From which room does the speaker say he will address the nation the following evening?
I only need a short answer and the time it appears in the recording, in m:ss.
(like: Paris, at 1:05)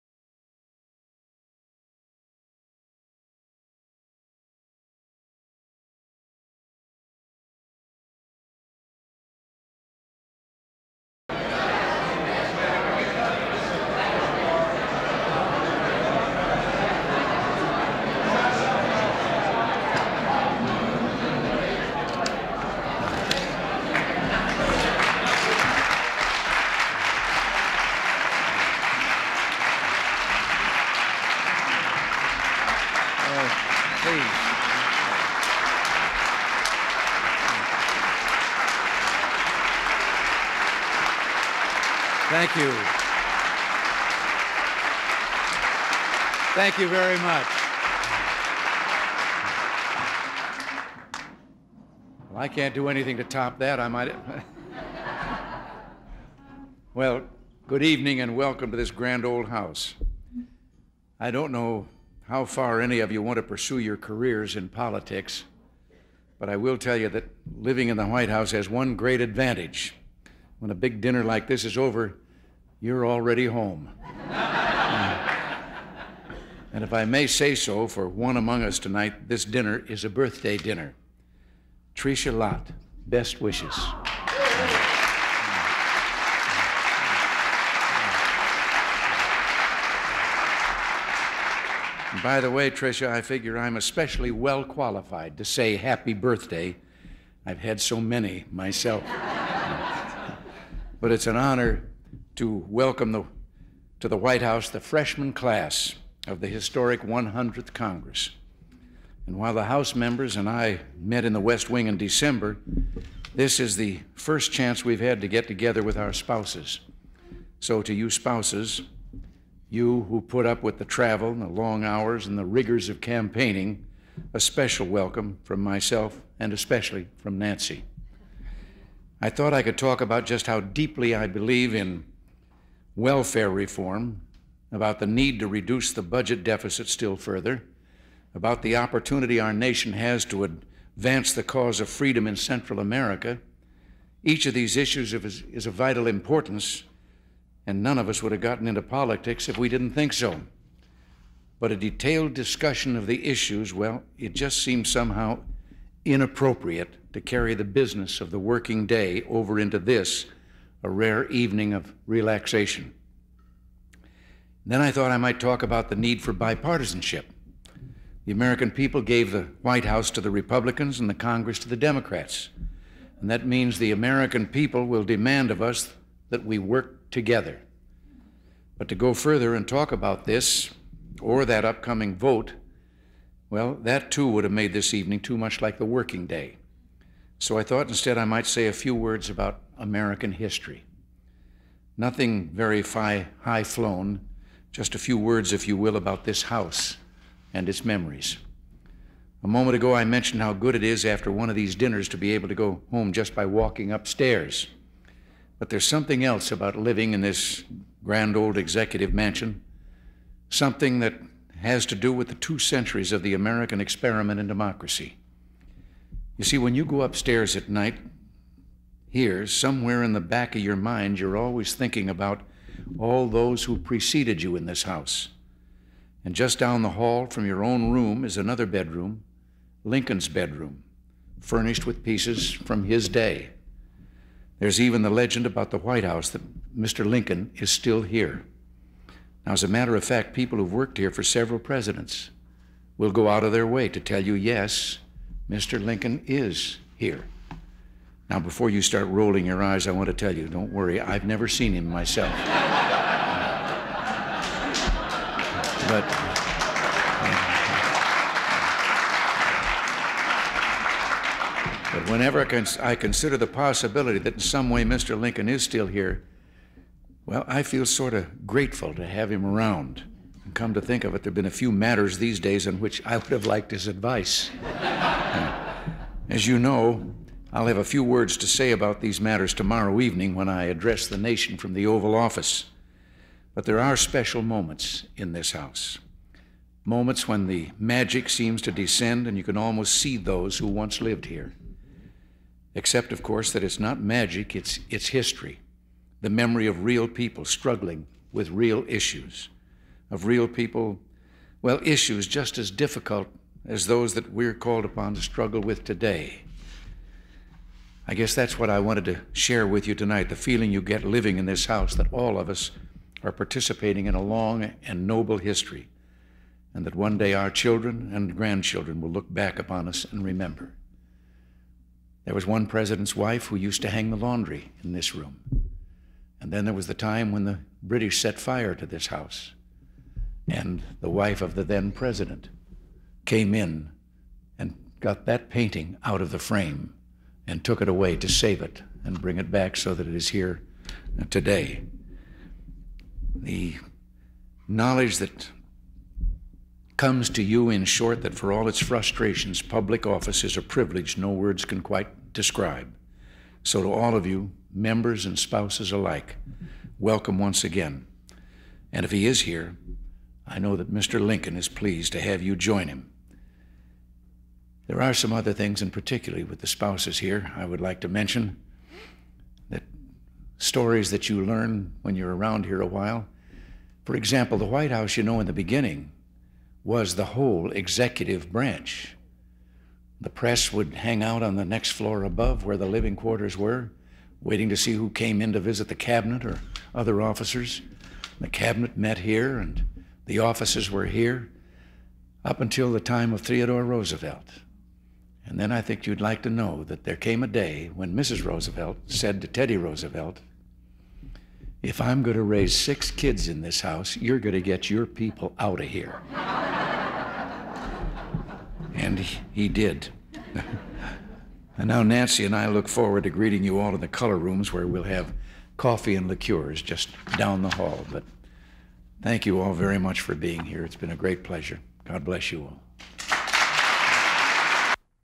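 Oval Office, at 4:41.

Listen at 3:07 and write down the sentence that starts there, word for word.
So I thought instead I might say a few words about American history.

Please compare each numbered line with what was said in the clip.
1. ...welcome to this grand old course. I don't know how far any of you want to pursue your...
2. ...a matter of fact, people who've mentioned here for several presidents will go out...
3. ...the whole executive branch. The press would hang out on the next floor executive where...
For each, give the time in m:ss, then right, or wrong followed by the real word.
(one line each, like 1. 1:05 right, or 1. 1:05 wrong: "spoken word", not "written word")
1. 0:58 wrong: "house", not "course"
2. 3:59 wrong: "worked", not "mentioned"
3. 6:17 wrong: "above", not "executive".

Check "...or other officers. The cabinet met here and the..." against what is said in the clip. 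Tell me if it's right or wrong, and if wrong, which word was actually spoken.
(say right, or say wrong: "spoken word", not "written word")
right.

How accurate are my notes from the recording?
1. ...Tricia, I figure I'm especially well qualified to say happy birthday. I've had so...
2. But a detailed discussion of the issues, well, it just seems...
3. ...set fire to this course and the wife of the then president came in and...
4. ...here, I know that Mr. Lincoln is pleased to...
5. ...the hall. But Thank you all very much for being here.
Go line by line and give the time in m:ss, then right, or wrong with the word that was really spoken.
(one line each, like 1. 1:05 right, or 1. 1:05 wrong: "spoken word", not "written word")
1. 1:32 right
2. 2:31 right
3. 5:28 wrong: "house", not "course"
4. 5:59 right
5. 6:57 right.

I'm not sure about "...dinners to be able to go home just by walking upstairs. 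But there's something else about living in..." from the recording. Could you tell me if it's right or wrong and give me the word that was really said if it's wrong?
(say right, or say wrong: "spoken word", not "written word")
right.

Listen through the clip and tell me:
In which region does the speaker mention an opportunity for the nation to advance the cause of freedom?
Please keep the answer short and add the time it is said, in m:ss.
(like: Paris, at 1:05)
Central America, at 2:22.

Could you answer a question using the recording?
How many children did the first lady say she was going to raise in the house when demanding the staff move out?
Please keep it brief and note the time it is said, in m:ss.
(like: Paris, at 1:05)
6, at 6:42.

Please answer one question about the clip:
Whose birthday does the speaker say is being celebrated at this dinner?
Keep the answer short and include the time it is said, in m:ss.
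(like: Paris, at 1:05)
Tricia Lott, at 1:21.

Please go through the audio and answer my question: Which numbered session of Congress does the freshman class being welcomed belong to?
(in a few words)
100th.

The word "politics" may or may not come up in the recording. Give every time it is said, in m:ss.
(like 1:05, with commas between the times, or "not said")
1:04, 2:28.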